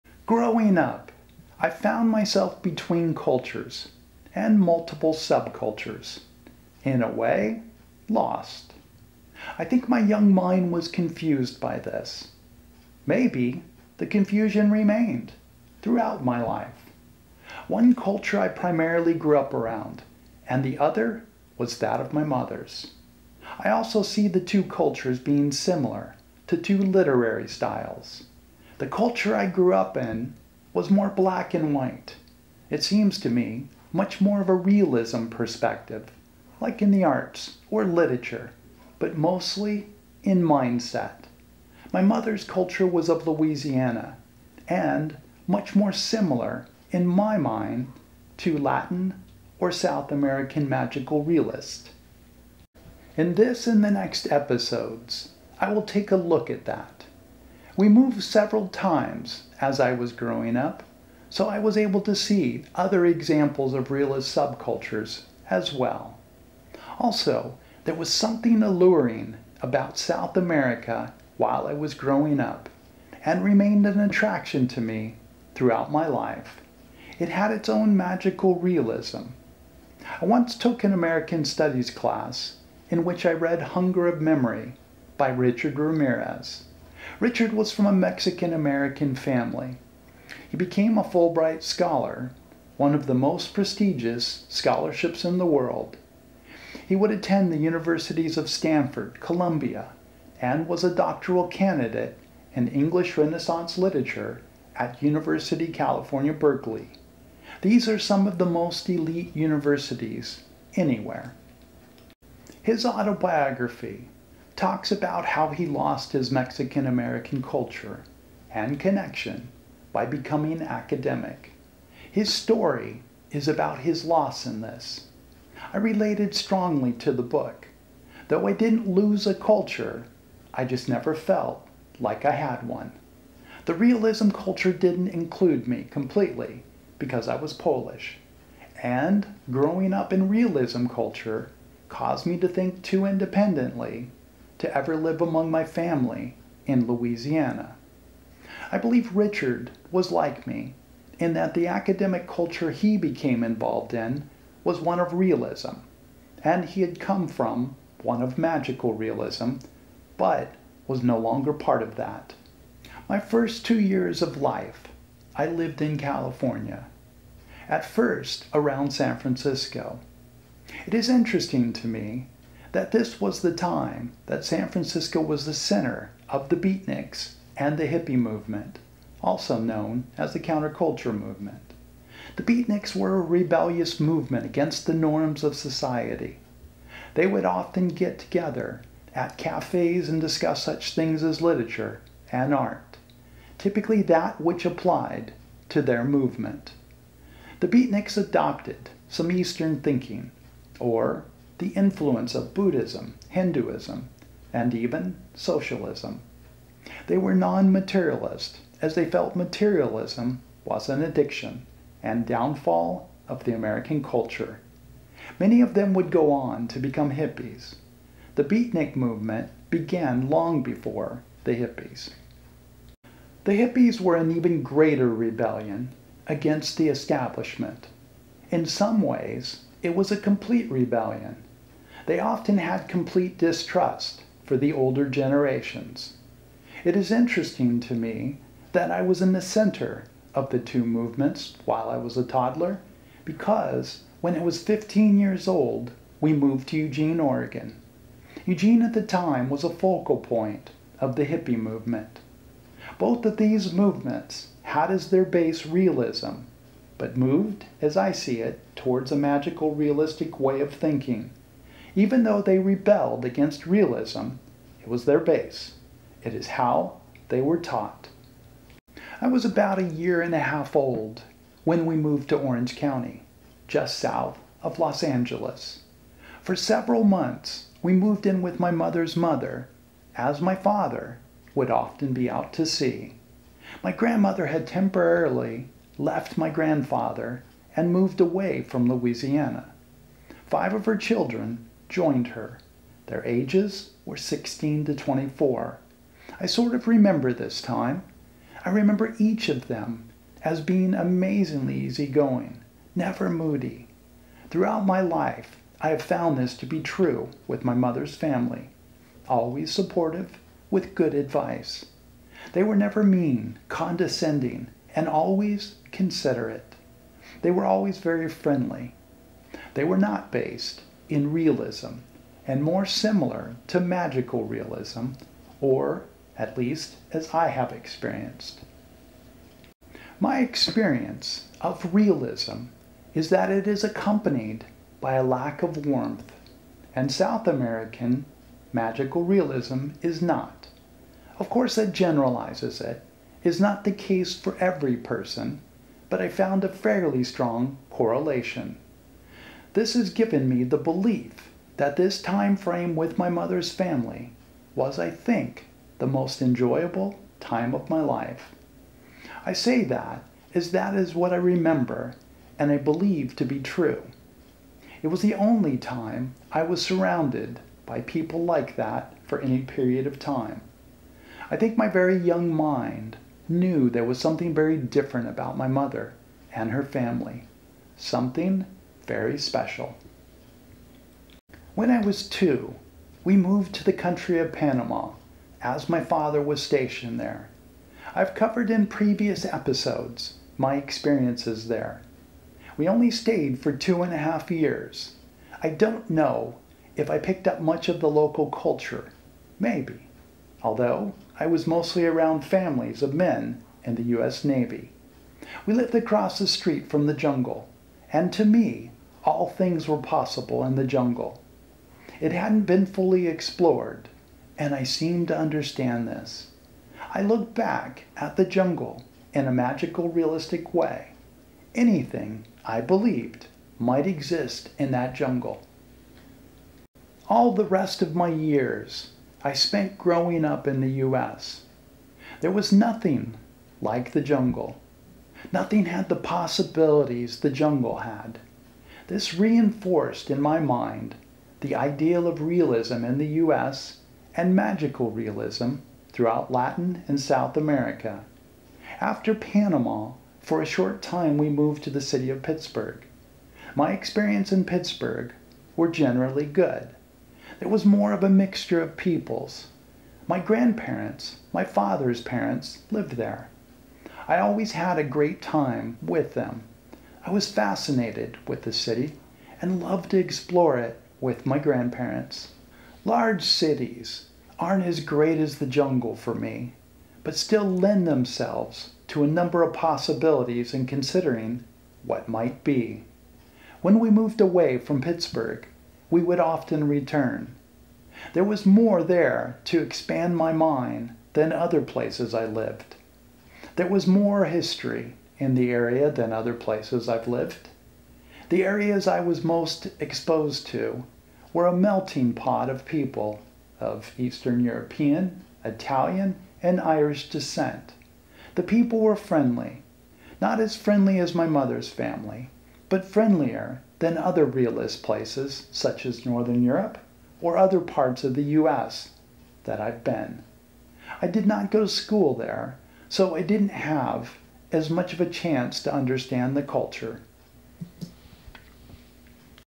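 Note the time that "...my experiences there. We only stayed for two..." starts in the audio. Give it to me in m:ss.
6:30.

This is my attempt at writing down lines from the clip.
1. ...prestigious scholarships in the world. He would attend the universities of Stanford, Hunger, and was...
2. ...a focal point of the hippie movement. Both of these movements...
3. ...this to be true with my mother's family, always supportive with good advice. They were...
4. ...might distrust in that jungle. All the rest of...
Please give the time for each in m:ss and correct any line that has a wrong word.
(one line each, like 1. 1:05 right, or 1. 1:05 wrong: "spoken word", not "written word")
1. 1:33 wrong: "Columbia", not "Hunger"
2. 4:09 right
3. 5:06 right
4. 7:03 wrong: "exist", not "distrust".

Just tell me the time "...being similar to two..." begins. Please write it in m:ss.
0:25.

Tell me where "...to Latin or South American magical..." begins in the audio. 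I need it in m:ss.
0:48.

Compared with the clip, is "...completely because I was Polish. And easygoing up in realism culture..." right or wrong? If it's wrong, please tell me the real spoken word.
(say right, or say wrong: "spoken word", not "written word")
wrong: "growing", not "easygoing".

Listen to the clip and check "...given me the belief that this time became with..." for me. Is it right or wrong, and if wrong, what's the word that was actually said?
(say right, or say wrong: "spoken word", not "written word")
wrong: "frame", not "became".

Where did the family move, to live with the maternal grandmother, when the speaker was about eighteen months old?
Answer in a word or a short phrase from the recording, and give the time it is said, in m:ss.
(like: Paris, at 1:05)
Orange County, at 4:32.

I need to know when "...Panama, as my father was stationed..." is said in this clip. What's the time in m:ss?
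6:24.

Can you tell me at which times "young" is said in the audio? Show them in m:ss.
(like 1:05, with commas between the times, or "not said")
0:09, 6:12.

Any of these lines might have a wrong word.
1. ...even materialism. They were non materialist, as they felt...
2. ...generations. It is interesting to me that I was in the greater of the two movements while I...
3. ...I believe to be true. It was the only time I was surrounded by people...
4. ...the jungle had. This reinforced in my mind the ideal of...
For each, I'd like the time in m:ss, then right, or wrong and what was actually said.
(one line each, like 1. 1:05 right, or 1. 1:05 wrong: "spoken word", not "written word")
1. 3:24 wrong: "socialism", not "materialism"
2. 3:55 wrong: "center", not "greater"
3. 6:02 right
4. 7:17 right.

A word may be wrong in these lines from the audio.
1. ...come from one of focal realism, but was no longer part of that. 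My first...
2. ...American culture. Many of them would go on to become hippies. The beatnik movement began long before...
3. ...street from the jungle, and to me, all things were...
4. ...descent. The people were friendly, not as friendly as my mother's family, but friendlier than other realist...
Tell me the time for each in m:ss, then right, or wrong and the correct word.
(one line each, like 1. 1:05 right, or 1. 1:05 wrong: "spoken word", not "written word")
1. 2:36 wrong: "magical", not "focal"
2. 3:33 right
3. 6:46 right
4. 8:27 right.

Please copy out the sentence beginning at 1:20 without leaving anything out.
I once took an American Studies class in which I read Hunger of Memory by Richard Ramirez.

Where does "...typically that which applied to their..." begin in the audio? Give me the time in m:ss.
3:13.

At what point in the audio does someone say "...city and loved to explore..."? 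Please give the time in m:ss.
7:48.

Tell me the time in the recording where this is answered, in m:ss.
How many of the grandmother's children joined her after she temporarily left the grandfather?
4:50.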